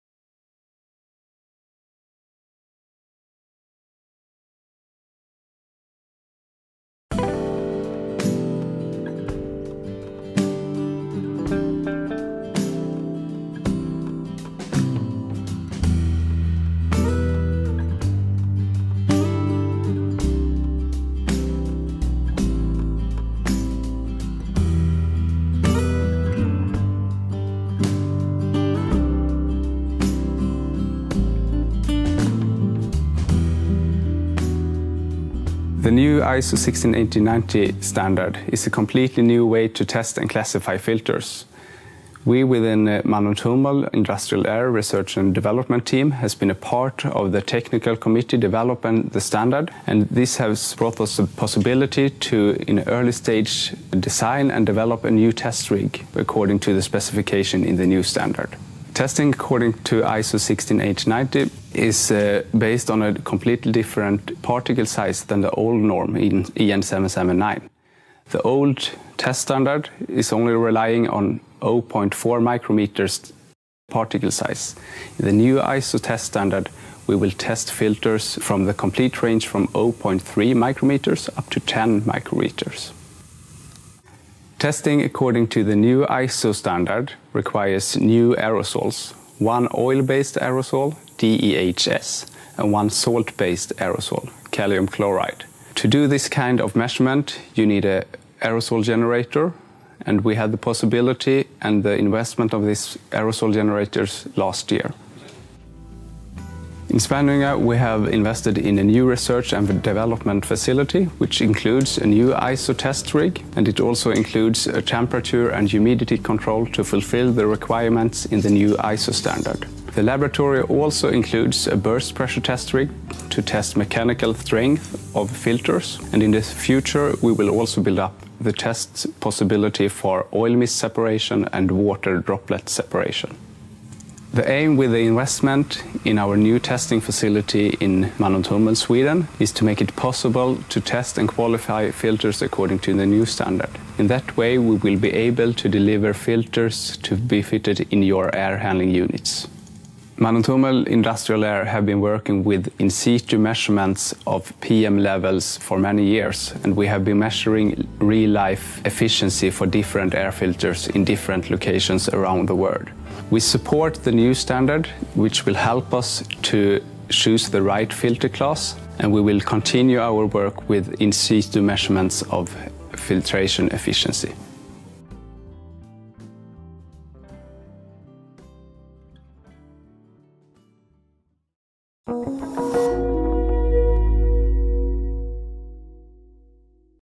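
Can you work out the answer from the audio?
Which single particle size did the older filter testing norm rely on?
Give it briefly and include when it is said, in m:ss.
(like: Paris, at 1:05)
0.4 micrometers, at 1:11.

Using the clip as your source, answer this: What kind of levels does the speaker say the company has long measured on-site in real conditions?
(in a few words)
PM levels.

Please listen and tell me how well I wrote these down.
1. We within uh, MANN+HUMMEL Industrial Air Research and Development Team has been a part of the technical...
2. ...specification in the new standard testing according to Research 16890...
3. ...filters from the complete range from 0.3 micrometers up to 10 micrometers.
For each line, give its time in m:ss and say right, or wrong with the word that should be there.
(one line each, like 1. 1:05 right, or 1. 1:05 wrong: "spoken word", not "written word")
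1. 0:42 right
2. 0:56 wrong: "ISO", not "Research"
3. 1:17 right.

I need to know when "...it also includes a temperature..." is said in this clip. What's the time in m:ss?
1:53.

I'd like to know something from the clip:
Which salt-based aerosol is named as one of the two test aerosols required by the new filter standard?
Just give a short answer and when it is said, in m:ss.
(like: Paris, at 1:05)
calcium chloride, at 1:34.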